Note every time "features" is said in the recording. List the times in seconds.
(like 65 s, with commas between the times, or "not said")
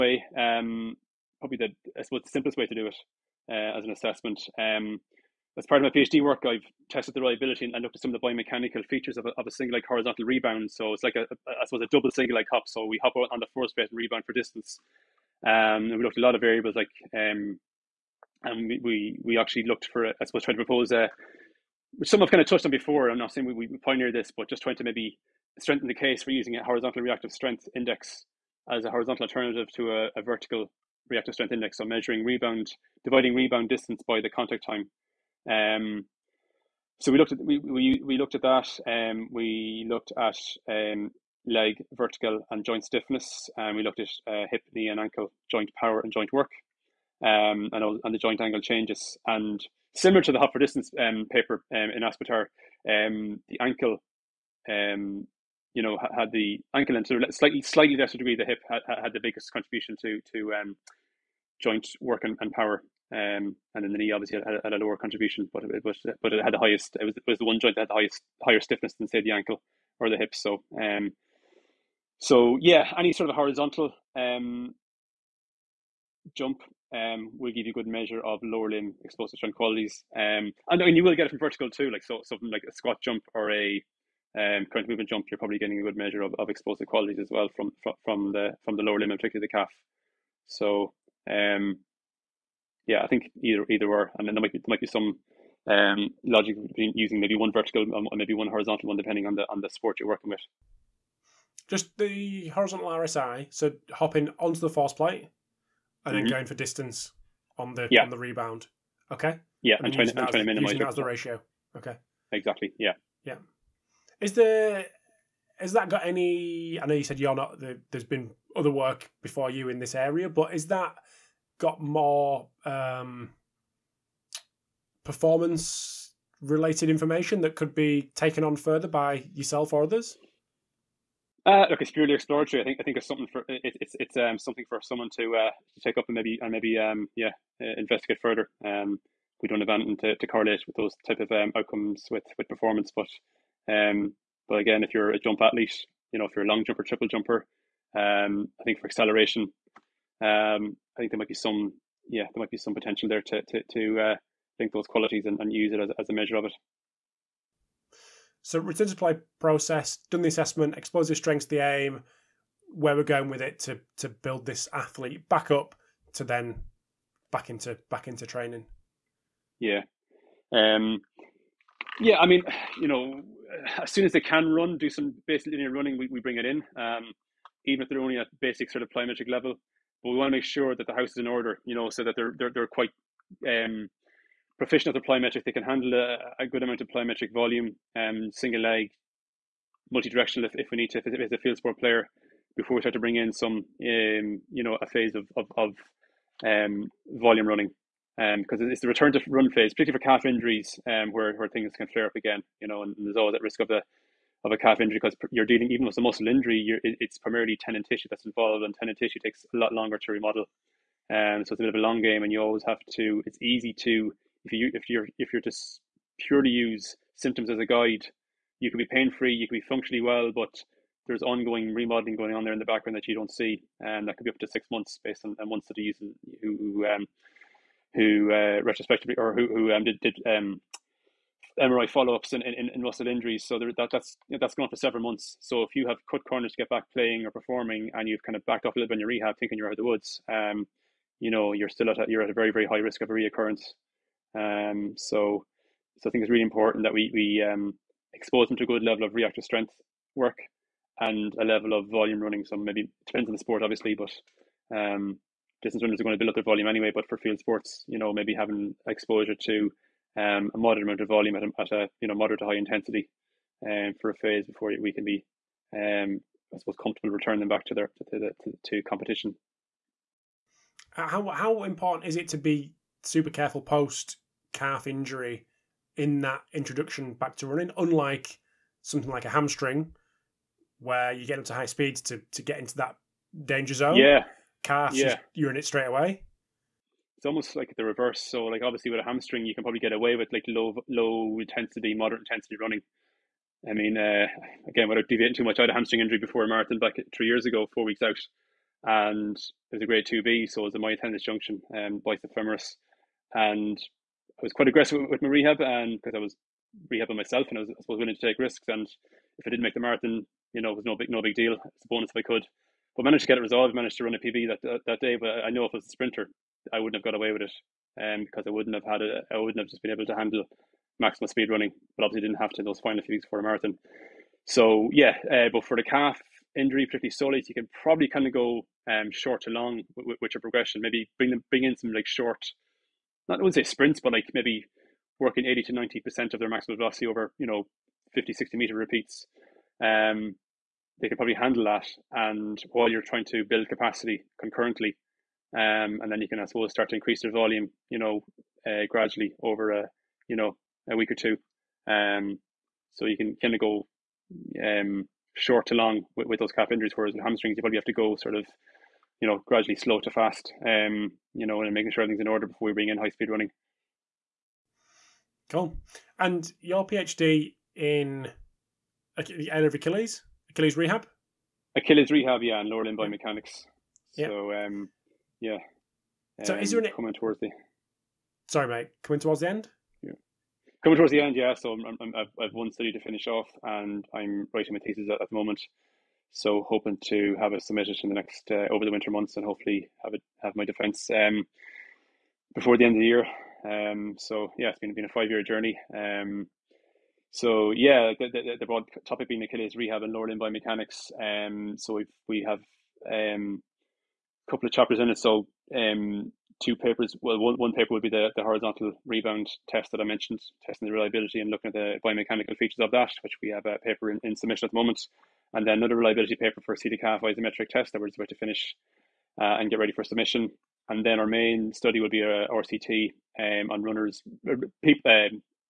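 8 s, 412 s.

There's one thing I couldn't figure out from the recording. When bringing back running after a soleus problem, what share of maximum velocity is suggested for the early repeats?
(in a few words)
80 to 90 percent.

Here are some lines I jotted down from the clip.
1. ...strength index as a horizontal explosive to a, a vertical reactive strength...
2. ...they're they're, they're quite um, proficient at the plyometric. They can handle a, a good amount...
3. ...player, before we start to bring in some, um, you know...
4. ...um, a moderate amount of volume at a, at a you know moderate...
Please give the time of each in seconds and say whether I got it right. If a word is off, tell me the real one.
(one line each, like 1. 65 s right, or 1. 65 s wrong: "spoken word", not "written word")
1. 27 s wrong: "alternative", not "explosive"
2. 182 s right
3. 191 s right
4. 260 s right.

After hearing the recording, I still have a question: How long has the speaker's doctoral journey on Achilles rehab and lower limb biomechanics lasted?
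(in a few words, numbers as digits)
5 years.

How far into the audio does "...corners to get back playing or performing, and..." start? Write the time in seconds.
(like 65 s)
236 s.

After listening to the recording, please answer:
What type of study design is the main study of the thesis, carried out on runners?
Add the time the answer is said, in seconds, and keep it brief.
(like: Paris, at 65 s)
RCT, at 422 s.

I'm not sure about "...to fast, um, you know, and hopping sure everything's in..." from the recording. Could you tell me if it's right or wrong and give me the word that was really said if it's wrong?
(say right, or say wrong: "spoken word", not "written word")
wrong: "making", not "hopping".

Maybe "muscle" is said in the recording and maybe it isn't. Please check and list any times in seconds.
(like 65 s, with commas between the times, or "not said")
206 s, 232 s.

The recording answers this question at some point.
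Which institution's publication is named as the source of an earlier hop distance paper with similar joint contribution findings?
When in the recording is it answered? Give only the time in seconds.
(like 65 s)
52 s.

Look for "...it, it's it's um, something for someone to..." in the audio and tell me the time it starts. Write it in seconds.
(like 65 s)
133 s.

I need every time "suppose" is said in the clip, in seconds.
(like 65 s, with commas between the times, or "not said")
2 s, 11 s, 20 s, 266 s, 307 s, 346 s.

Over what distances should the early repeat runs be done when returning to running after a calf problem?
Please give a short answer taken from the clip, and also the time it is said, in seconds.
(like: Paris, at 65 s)
50 to 60 meters, at 338 s.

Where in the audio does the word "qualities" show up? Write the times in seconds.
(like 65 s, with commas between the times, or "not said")
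79 s, 86 s, 154 s.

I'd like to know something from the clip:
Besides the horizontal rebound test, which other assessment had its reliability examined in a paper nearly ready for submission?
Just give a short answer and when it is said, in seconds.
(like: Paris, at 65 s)
seated calf isometric test, at 416 s.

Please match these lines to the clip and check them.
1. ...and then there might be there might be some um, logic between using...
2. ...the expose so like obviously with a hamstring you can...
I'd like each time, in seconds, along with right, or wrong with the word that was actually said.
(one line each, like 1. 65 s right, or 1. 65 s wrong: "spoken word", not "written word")
1. 94 s right
2. 287 s wrong: "reverse", not "expose".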